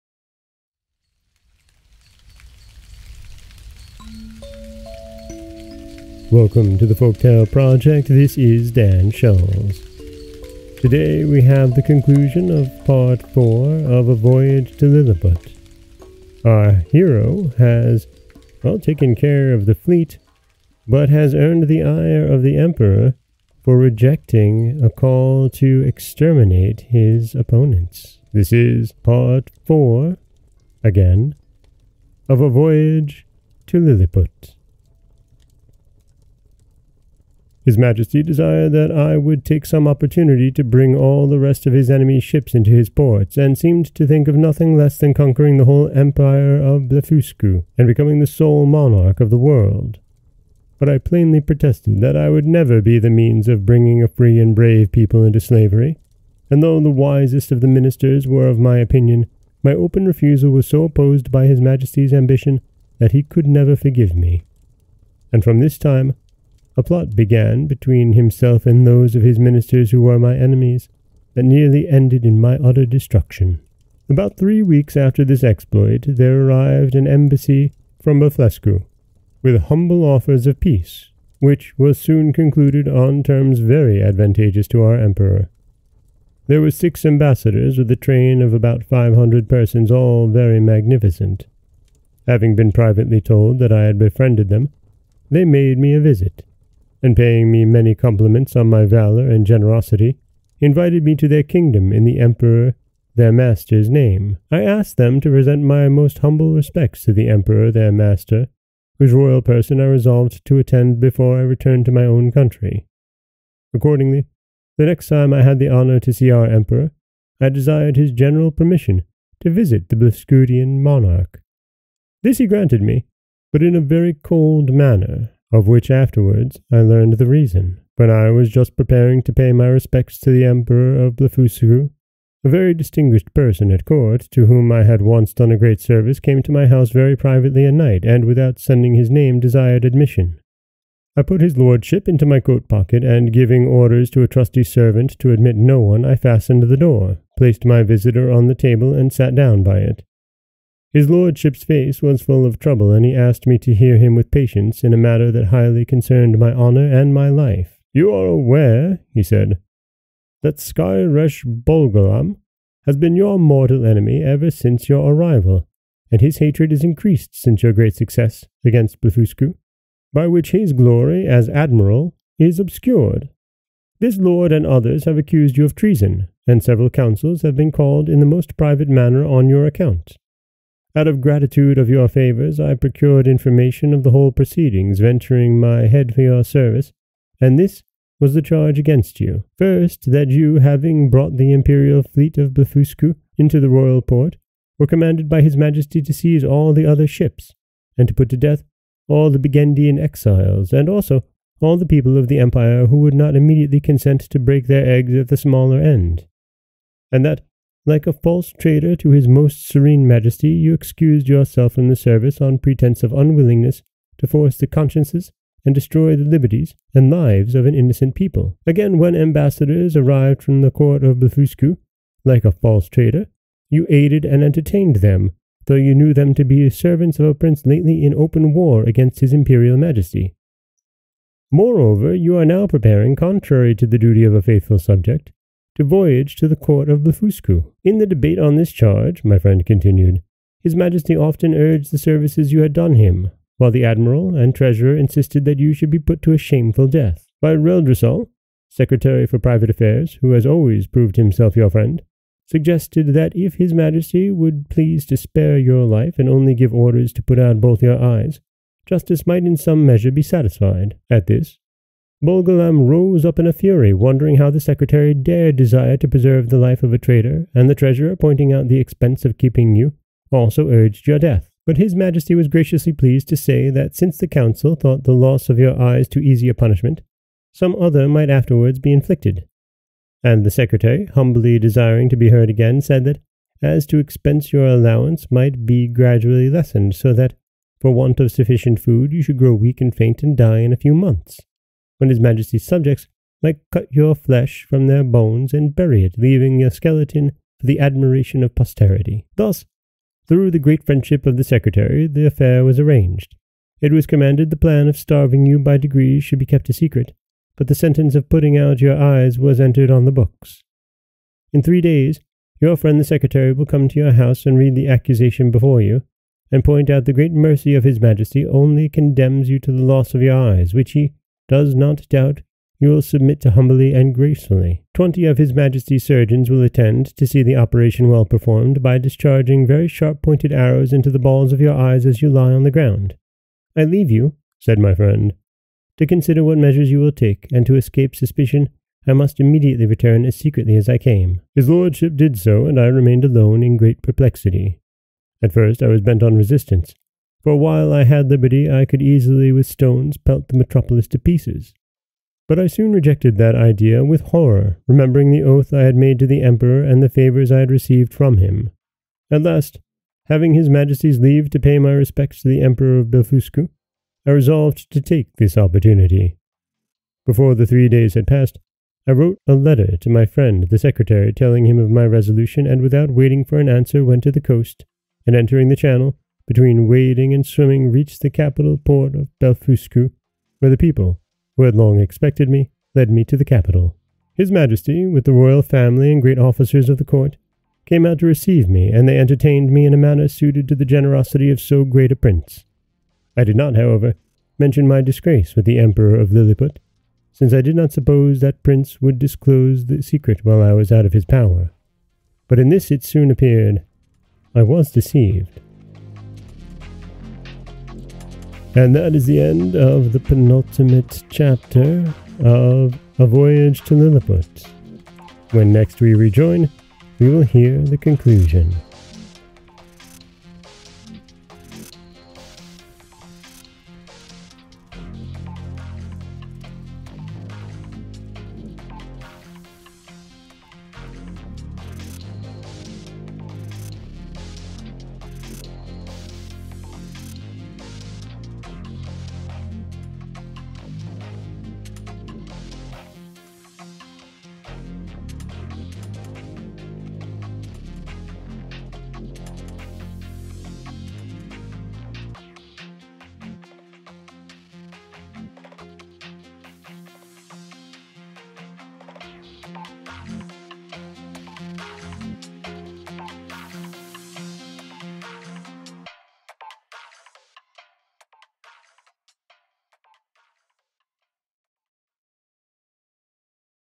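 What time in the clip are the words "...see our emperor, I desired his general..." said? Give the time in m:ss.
1:56.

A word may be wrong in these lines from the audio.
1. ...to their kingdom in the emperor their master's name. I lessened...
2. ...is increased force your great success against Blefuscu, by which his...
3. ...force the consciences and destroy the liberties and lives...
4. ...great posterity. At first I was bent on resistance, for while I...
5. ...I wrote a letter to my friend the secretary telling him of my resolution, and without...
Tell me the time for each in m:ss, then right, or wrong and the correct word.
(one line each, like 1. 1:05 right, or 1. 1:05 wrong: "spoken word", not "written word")
1. 1:41 wrong: "asked", not "lessened"
2. 2:46 wrong: "since", not "force"
3. 3:34 right
4. 5:43 wrong: "perplexity", not "posterity"
5. 6:09 right.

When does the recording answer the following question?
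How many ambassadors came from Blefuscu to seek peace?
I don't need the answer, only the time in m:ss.
1:26.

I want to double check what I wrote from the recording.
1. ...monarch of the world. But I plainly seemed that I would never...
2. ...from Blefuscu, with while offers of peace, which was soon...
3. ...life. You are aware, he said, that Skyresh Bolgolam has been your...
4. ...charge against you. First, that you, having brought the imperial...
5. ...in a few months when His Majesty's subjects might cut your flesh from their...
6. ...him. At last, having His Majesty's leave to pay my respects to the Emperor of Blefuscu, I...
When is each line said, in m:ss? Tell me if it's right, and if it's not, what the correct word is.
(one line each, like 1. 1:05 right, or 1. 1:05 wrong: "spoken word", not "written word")
1. 0:48 wrong: "protested", not "seemed"
2. 1:18 wrong: "humble", not "while"
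3. 2:37 right
4. 3:08 right
5. 4:50 right
6. 5:58 right.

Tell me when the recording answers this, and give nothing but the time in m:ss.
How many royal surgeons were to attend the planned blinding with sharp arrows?
5:24.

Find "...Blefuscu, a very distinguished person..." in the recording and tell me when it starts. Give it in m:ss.
2:11.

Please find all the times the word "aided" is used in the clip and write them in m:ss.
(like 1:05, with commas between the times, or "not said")
3:43.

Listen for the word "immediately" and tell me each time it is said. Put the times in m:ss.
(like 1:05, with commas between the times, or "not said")
3:23, 5:39.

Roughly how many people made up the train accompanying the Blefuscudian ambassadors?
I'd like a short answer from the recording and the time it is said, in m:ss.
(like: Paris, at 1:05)
500, at 1:28.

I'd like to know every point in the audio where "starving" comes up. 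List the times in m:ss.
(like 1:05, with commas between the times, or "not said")
5:04.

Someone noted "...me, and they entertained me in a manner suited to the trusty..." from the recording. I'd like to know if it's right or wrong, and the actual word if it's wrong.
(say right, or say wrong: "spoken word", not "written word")
wrong: "generosity", not "trusty".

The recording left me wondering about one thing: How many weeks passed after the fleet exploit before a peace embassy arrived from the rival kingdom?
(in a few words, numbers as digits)
3.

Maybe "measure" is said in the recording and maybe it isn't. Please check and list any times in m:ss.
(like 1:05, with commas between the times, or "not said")
4:19, 5:36.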